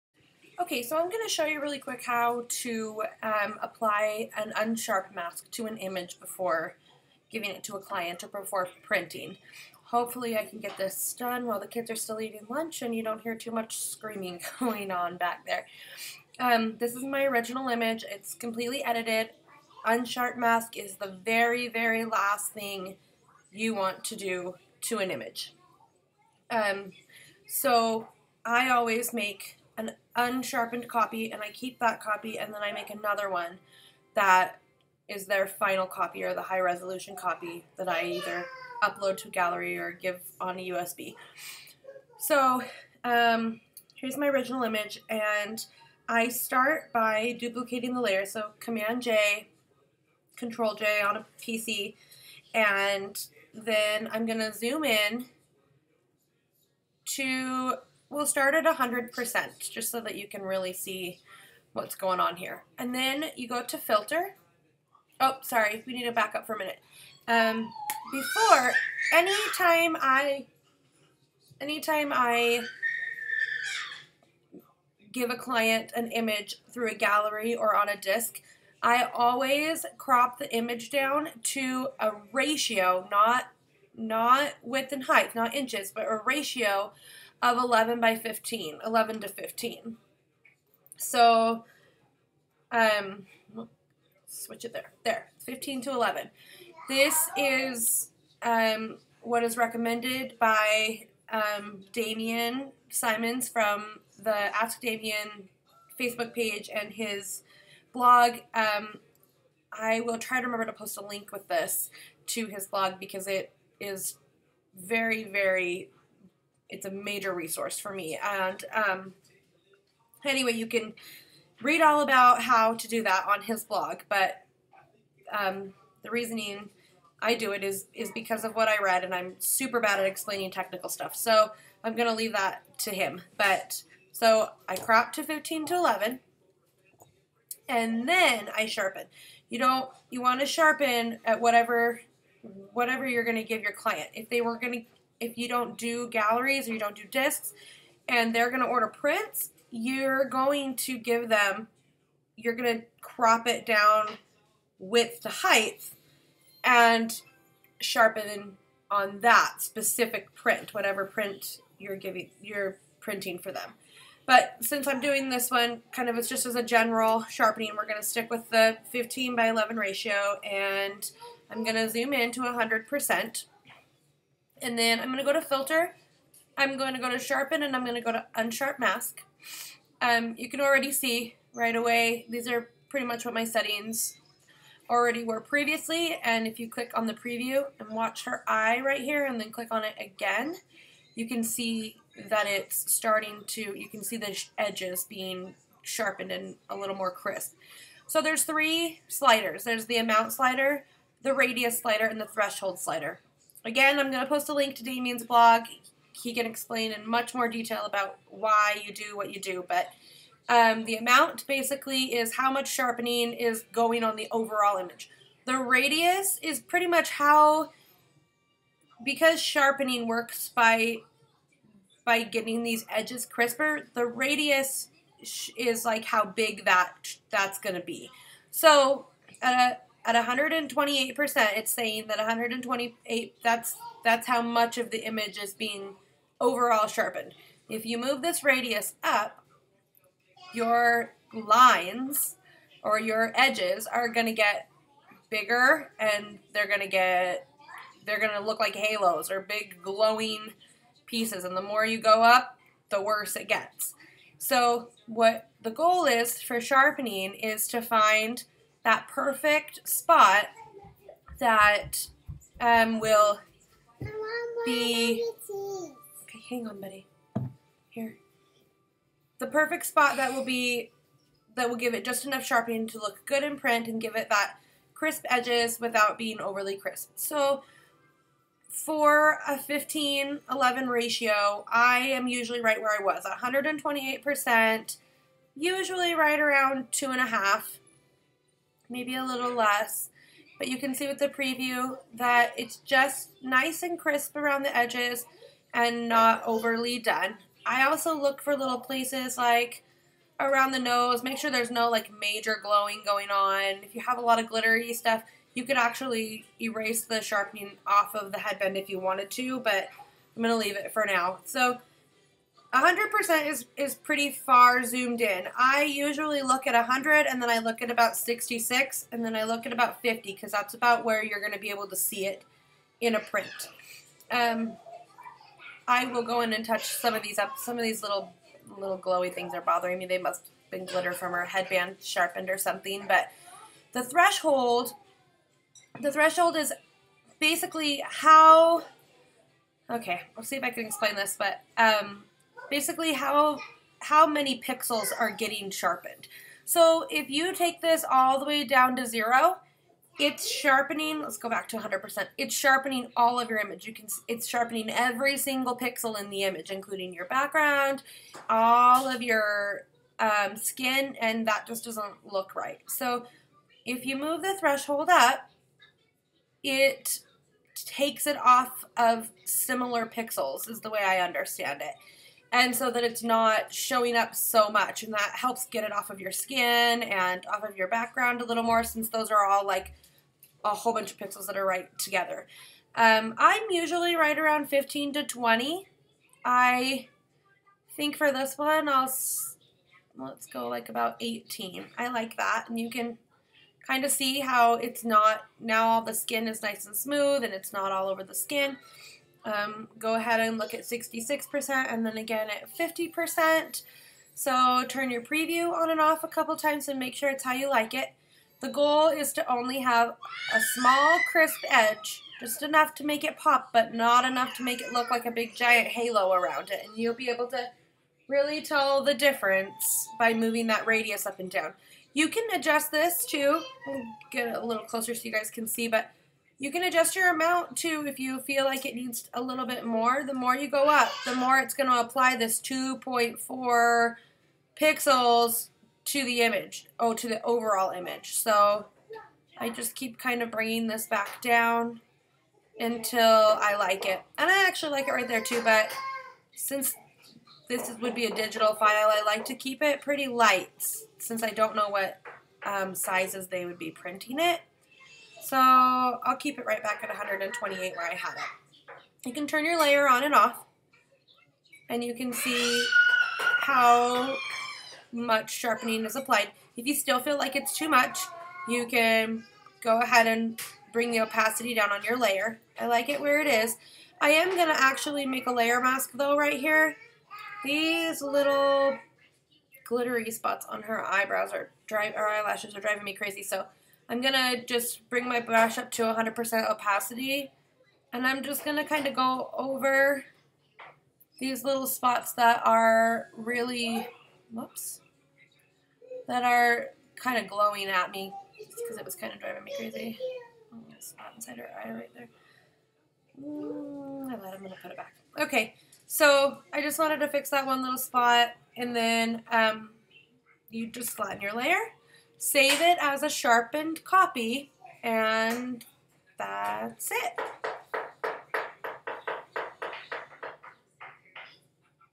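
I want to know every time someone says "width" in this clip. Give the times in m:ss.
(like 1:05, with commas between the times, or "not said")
1:24, 2:34.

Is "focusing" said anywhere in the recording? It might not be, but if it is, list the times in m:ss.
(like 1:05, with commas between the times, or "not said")
not said.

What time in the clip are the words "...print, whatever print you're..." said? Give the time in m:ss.
2:40.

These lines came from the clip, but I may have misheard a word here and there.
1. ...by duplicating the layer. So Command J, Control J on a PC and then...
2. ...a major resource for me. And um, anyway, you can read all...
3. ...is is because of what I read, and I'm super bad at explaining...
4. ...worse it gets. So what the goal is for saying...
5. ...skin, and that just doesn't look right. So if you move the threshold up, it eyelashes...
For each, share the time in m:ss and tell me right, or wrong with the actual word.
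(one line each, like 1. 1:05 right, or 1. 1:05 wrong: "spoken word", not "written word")
1. 0:46 right
2. 1:56 right
3. 2:07 right
4. 4:13 wrong: "sharpening", not "saying"
5. 6:00 wrong: "takes", not "eyelashes".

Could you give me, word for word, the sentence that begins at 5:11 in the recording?
So 100% is, is pretty far zoomed in.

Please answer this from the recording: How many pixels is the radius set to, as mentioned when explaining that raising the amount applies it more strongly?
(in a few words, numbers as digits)
2.4 pixels.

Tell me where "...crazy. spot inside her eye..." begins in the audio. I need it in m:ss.
8:19.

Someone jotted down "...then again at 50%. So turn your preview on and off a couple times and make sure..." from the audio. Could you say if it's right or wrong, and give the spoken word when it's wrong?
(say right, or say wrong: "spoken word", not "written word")
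right.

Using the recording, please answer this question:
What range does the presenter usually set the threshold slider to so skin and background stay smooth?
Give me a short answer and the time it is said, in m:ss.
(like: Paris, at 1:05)
15 to 20, at 6:24.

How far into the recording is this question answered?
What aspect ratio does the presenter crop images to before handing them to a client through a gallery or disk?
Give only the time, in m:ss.
1:28.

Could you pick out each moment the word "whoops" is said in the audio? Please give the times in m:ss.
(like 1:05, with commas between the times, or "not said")
8:14.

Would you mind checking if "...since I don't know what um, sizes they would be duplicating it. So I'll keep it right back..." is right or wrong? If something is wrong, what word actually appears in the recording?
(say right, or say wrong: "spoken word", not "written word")
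wrong: "printing", not "duplicating".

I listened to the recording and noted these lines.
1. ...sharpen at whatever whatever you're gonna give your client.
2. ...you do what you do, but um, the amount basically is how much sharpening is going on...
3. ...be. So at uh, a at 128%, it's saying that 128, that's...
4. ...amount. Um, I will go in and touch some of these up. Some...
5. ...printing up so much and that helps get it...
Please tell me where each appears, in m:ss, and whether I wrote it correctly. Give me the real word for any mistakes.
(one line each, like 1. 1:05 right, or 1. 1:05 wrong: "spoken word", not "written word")
1. 2:20 right
2. 3:28 right
3. 3:47 right
4. 5:23 wrong: "print", not "amount"
5. 6:13 wrong: "showing", not "printing".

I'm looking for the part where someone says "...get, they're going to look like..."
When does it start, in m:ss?
4:06.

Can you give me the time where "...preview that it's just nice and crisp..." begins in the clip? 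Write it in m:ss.
4:51.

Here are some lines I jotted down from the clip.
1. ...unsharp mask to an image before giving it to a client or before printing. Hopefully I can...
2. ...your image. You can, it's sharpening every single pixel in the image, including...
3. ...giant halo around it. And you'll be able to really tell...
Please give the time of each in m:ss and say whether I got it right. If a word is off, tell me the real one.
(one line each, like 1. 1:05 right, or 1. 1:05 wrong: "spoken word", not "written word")
1. 0:04 right
2. 5:53 right
3. 6:55 right.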